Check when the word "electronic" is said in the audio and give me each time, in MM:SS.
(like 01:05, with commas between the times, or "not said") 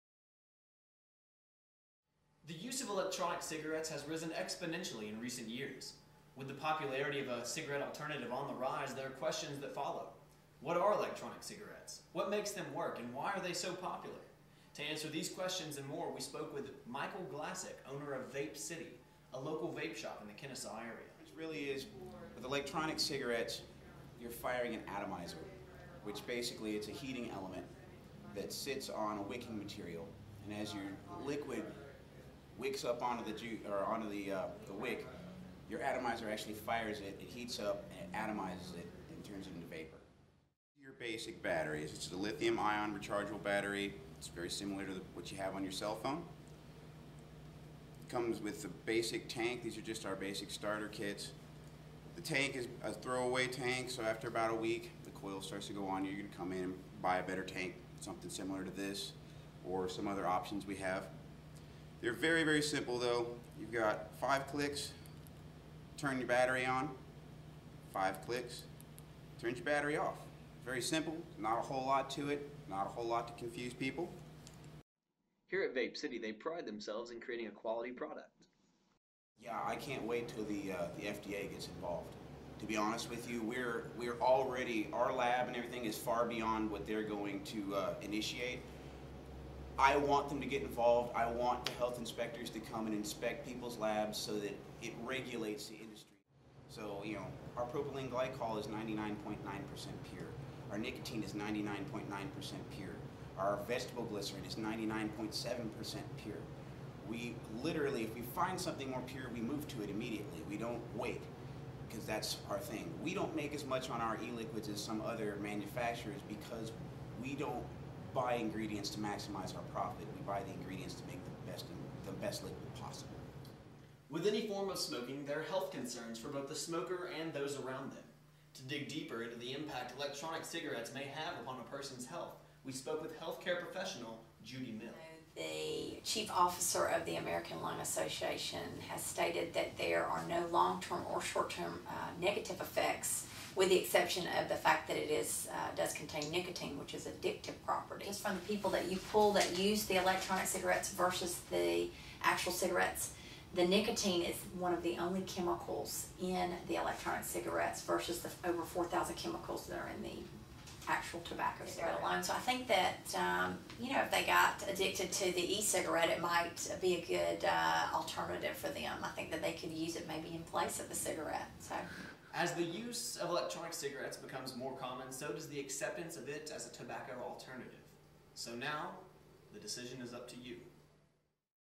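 00:02, 00:10, 00:22, 02:09, 02:30, 02:36, 02:53.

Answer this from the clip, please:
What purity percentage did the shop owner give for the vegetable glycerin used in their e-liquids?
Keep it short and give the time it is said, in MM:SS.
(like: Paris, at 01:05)
99.7%, at 01:44.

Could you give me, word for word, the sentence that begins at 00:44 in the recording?
It's very similar to the, what you have on your cell phone.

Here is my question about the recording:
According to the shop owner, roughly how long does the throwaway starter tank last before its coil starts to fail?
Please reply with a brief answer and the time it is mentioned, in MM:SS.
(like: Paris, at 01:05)
about a week, at 00:54.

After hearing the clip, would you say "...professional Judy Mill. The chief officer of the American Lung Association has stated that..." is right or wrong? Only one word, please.
right.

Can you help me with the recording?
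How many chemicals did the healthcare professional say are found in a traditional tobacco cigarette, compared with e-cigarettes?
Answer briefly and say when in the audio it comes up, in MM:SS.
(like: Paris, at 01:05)
over 4,000, at 02:38.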